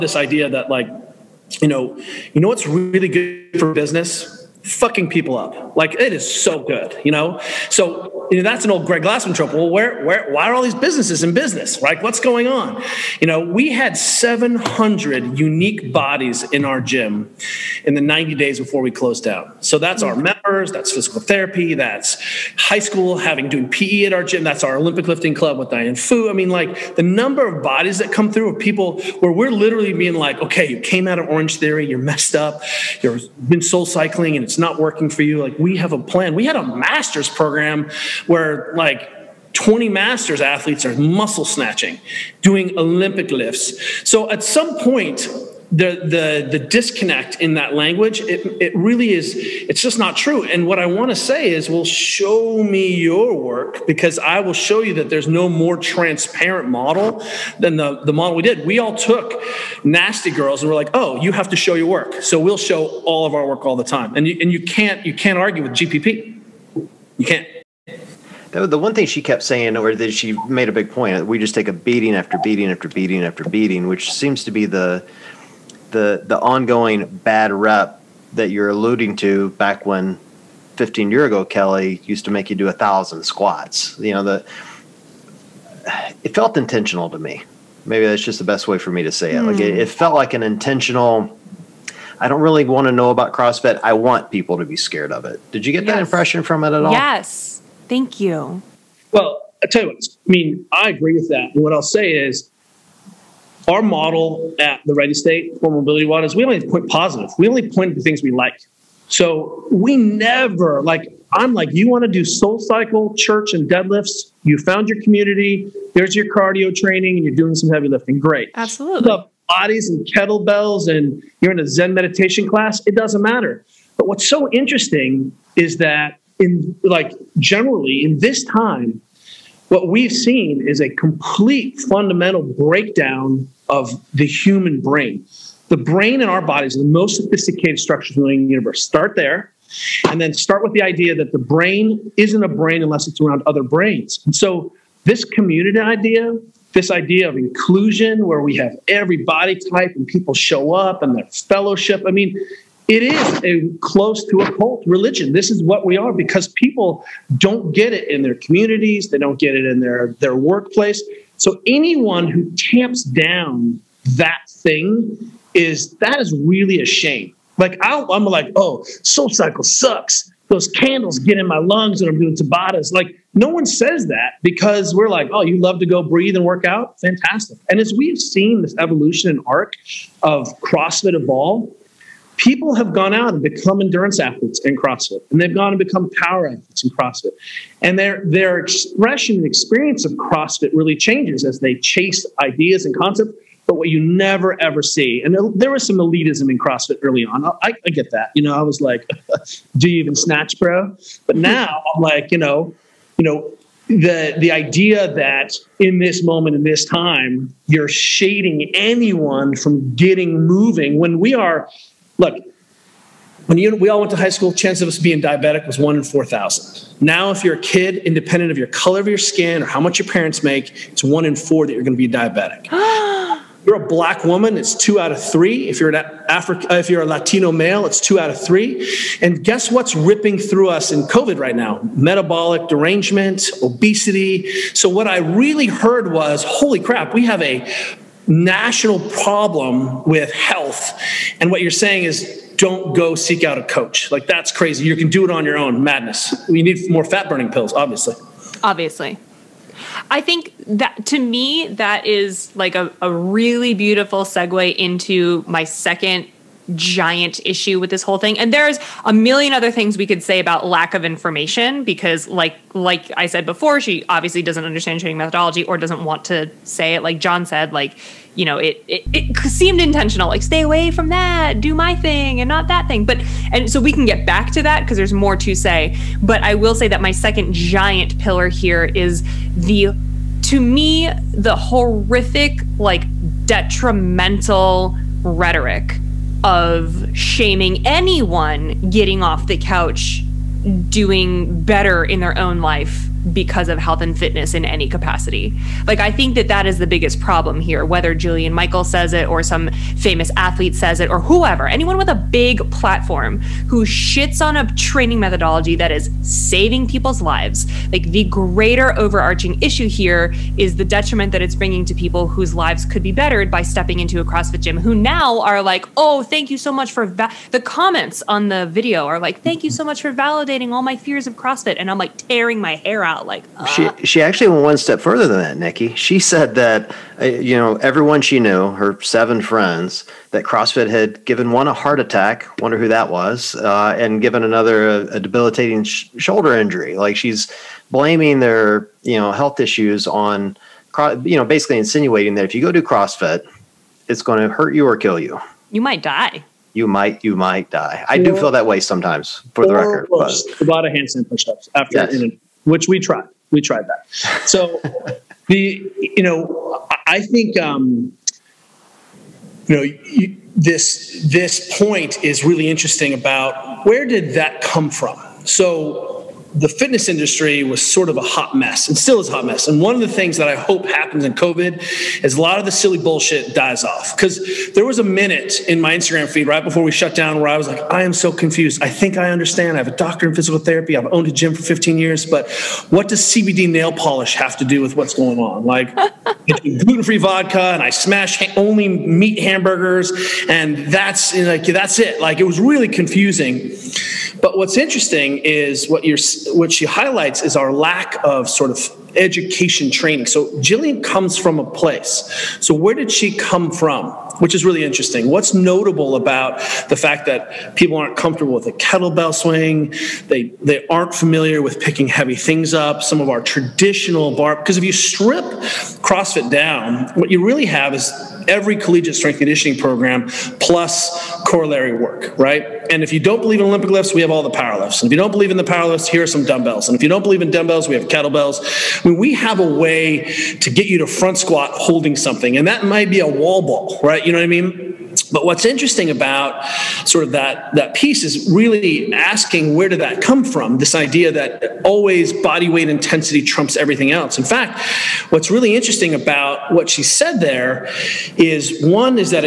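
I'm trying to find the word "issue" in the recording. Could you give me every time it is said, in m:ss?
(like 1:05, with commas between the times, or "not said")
4:17, 5:09, 5:39.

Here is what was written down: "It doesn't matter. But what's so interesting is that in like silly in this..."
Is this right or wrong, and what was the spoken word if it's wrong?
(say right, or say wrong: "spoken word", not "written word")
wrong: "generally", not "silly".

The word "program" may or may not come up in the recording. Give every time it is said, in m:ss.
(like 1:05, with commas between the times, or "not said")
0:37, 6:59.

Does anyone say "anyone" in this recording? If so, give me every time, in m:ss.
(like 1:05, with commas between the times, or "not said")
2:41, 3:28, 4:47, 5:01.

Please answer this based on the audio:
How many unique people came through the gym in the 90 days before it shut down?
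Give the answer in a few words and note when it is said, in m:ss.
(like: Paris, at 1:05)
700, at 0:13.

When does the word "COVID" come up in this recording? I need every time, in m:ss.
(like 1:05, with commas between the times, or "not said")
3:51, 6:11.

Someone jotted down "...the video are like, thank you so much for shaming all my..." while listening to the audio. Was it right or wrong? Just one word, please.
wrong.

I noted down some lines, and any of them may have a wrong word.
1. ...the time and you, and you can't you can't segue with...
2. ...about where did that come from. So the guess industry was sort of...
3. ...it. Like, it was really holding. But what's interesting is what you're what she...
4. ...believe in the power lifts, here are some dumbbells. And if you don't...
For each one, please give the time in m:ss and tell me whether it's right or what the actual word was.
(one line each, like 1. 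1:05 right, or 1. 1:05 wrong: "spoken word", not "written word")
1. 1:03 wrong: "argue", not "segue"
2. 6:03 wrong: "fitness", not "guess"
3. 6:31 wrong: "confusing", not "holding"
4. 7:05 right.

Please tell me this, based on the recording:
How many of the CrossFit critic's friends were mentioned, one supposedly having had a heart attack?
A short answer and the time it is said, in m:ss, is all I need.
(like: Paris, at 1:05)
7, at 5:28.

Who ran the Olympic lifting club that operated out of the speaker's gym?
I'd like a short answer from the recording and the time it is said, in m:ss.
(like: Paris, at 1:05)
Diane Fu, at 0:25.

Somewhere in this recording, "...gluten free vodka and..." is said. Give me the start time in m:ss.
6:26.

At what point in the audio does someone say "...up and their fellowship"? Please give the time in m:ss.
2:30.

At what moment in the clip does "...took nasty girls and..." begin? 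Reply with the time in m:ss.
0:58.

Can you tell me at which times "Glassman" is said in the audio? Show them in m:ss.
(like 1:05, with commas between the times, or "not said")
0:09.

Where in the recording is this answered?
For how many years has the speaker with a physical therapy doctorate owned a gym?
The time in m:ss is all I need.
6:21.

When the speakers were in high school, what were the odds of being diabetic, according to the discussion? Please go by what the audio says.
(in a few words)
1 in 4,000.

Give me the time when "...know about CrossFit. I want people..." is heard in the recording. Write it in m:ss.
1:32.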